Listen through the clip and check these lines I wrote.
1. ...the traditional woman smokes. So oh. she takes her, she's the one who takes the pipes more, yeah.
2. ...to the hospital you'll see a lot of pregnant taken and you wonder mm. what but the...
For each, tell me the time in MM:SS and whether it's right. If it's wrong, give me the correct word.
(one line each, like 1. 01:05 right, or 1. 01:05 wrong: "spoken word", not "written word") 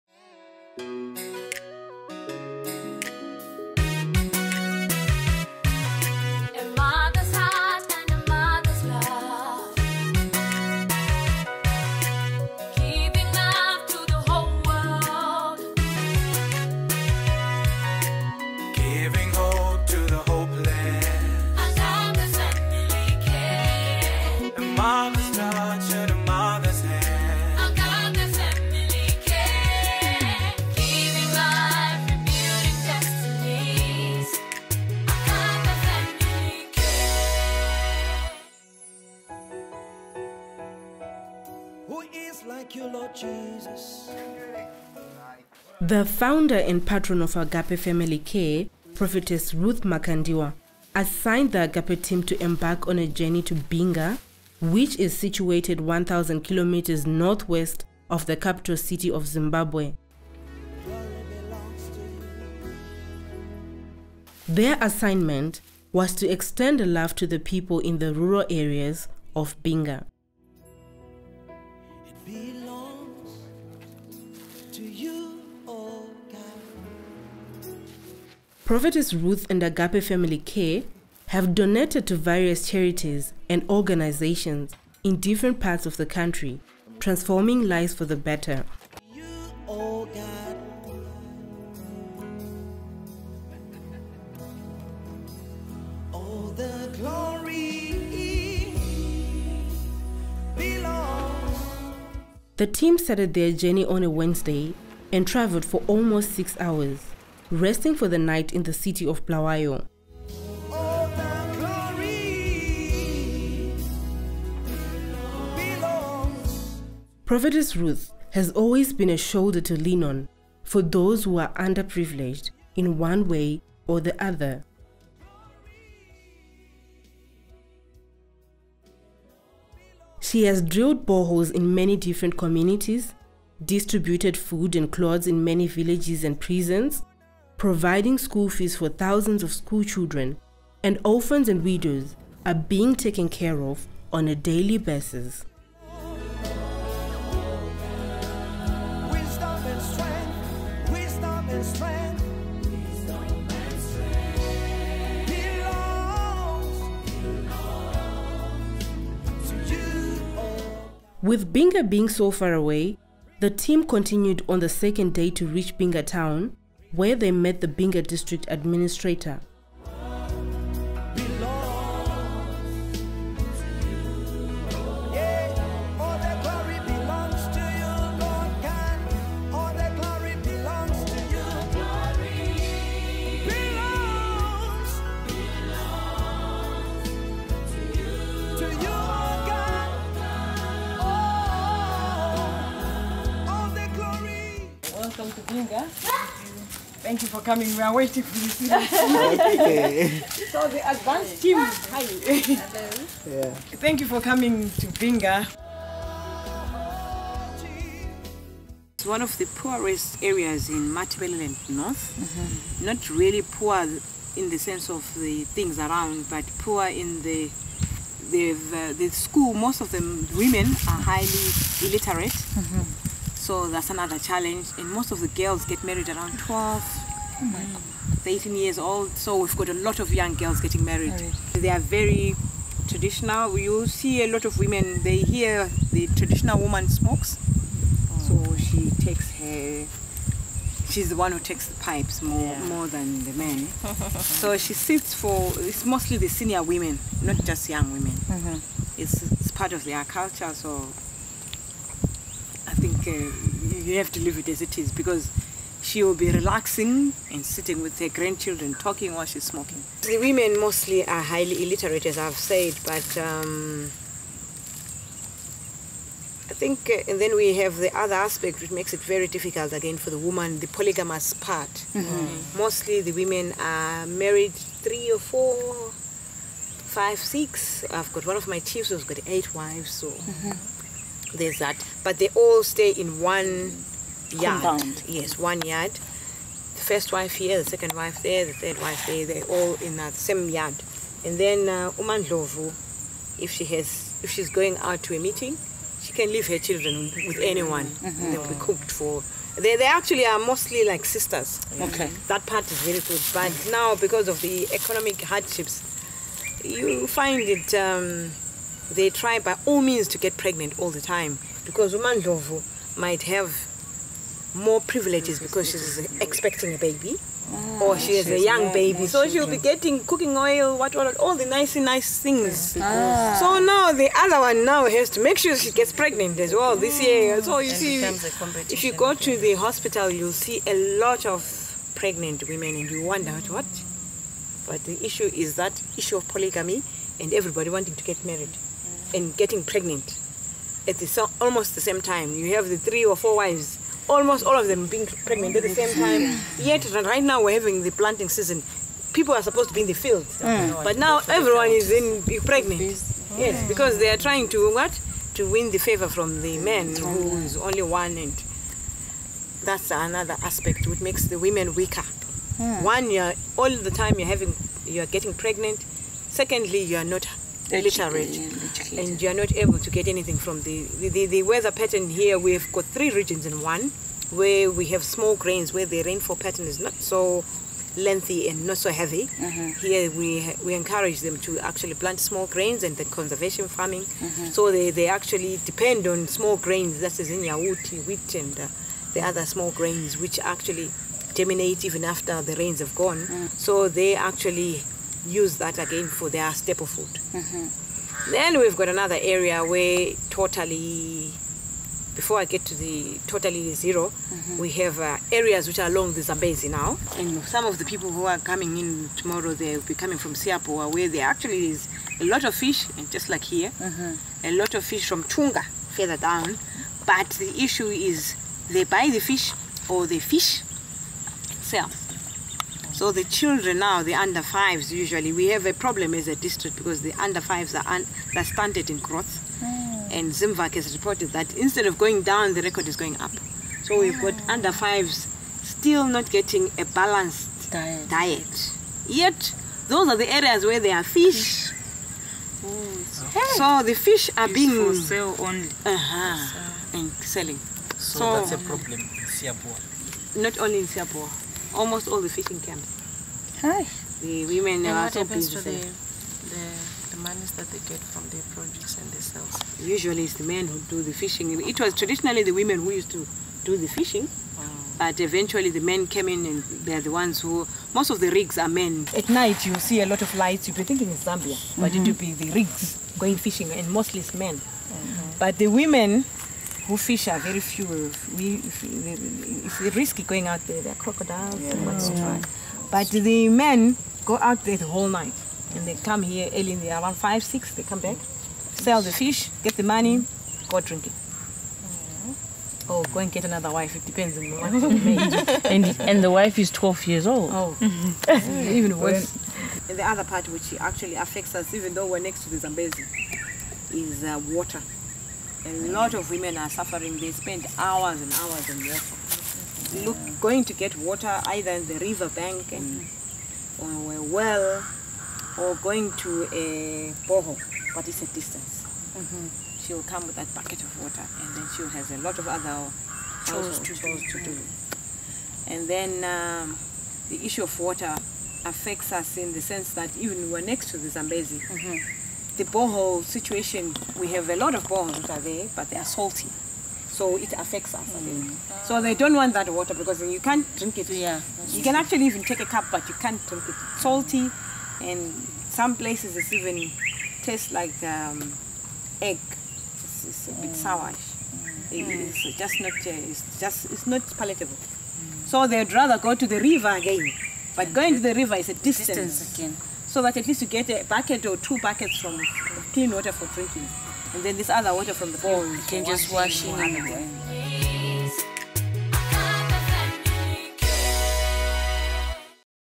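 1. 03:55 right
2. 05:29 wrong: "women", not "taken".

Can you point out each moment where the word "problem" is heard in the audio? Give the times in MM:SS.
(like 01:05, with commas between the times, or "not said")
07:05, 07:28.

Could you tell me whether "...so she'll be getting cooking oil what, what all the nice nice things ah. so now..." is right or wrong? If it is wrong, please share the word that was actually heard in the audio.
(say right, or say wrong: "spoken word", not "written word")
right.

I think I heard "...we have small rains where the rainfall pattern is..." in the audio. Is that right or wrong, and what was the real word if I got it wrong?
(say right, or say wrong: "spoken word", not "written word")
wrong: "grains", not "rains".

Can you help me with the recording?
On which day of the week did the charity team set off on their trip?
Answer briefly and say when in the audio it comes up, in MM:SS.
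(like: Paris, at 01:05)
Wednesday, at 01:44.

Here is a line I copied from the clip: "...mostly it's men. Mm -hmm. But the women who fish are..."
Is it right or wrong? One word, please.
right.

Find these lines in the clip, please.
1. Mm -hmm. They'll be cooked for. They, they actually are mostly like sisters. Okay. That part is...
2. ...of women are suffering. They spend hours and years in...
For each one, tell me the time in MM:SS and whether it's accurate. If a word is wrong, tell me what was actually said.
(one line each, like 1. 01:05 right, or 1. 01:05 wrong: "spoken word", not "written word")
1. 04:57 right
2. 08:26 wrong: "hours", not "years".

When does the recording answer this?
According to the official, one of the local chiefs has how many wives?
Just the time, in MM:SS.
04:39.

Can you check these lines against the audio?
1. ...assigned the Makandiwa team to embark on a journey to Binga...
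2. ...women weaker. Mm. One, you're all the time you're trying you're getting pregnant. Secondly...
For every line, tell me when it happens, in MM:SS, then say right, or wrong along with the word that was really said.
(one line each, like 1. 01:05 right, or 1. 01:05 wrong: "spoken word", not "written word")
1. 00:50 wrong: "Agape", not "Makandiwa"
2. 06:01 wrong: "having", not "trying".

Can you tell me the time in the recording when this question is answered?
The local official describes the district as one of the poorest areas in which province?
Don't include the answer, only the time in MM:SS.
03:30.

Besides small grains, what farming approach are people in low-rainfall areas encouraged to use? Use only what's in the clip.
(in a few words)
conservation farming.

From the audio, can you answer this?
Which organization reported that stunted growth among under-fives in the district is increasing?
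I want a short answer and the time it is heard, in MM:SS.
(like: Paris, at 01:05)
Zimvac, at 07:10.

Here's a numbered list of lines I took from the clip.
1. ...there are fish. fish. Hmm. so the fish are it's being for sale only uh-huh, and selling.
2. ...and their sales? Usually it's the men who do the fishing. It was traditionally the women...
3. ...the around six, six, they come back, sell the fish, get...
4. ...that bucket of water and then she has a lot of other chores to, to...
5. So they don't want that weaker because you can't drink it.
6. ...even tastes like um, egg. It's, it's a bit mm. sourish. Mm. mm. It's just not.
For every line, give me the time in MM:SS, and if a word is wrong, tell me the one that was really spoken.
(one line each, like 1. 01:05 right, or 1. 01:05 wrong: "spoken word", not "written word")
1. 07:20 right
2. 07:39 right
3. 08:06 wrong: "five", not "six"
4. 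08:40 right
5. 08:58 wrong: "water", not "weaker"
6. 09:06 right.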